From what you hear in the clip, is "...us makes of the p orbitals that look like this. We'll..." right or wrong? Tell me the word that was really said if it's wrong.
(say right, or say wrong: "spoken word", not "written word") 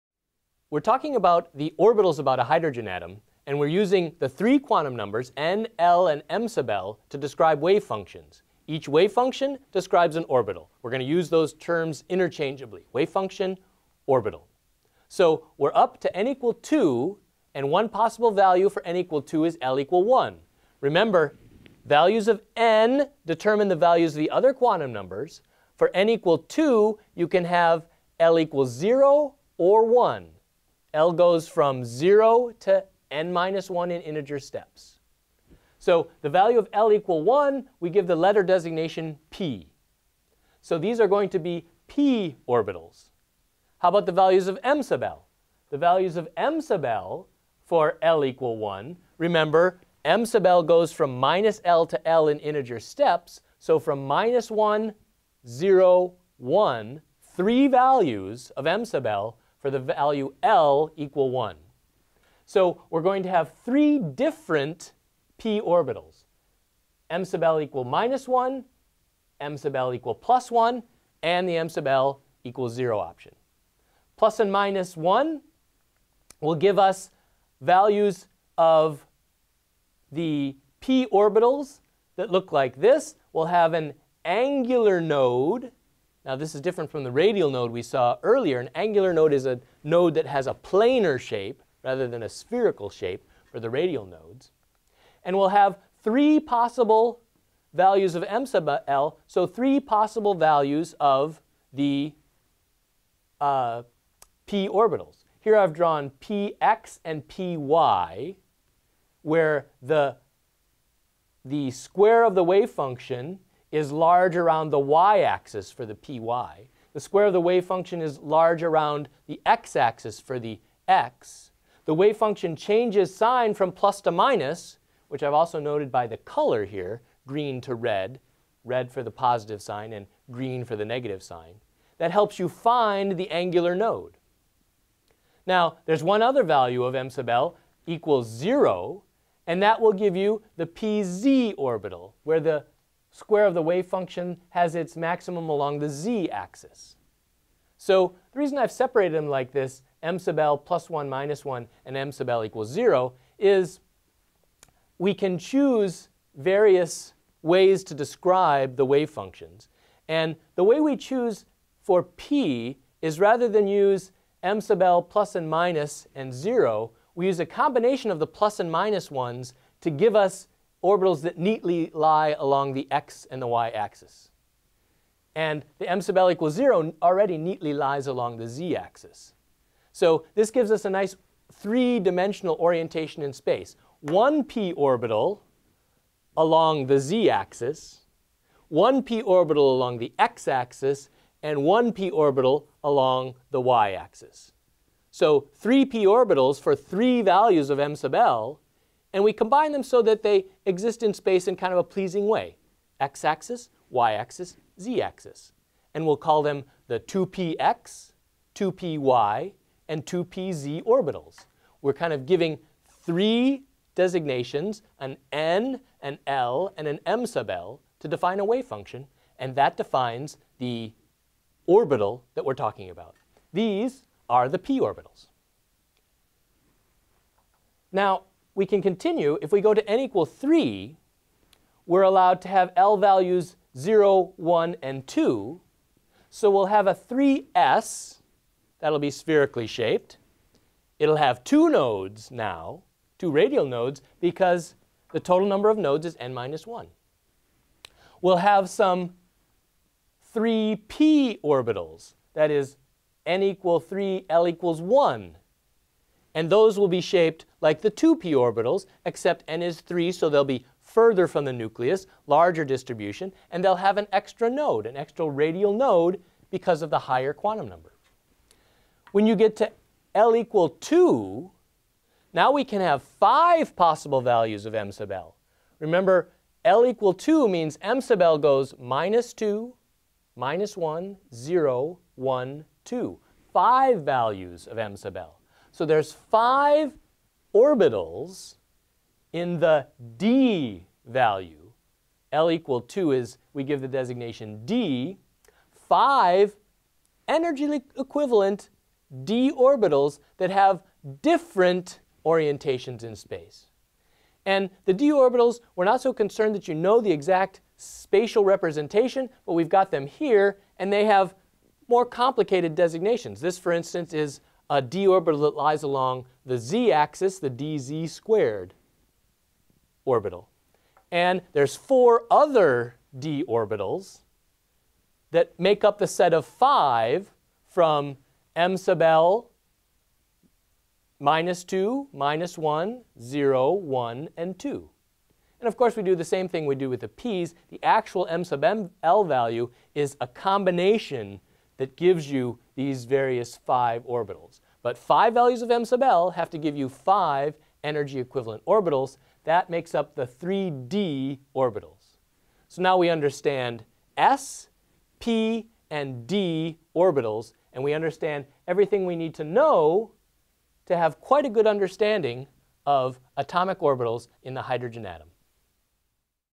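wrong: "values", not "makes".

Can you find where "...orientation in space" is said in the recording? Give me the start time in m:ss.
3:02.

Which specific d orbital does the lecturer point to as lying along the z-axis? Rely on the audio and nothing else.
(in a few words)
dz squared.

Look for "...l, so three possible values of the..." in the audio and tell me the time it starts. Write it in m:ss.
1:38.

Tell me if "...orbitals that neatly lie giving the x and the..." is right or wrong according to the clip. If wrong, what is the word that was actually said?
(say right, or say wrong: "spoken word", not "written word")
wrong: "along", not "giving".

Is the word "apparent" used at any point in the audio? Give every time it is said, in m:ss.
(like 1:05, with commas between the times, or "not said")
not said.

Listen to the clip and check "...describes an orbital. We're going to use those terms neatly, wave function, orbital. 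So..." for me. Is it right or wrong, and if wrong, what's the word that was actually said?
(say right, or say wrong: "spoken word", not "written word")
wrong: "interchangeably", not "neatly".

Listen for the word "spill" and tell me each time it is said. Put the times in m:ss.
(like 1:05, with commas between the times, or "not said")
not said.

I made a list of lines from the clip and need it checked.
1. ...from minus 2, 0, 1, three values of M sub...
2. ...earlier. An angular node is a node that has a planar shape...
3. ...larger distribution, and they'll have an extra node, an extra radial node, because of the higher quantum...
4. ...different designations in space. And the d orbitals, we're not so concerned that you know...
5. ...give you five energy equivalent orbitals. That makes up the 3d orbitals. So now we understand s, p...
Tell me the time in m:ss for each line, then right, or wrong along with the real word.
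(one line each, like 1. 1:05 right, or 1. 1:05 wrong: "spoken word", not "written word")
1. 0:53 wrong: "1", not "2"
2. 1:28 right
3. 4:22 right
4. 5:01 wrong: "orientations", not "designations"
5. 5:46 right.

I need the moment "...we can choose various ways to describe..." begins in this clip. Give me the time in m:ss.
2:34.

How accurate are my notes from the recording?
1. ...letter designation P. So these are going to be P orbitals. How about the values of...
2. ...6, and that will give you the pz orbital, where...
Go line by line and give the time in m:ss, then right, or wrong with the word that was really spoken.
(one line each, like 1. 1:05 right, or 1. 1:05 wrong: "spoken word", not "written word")
1. 0:38 right
2. 2:18 wrong: "0", not "6".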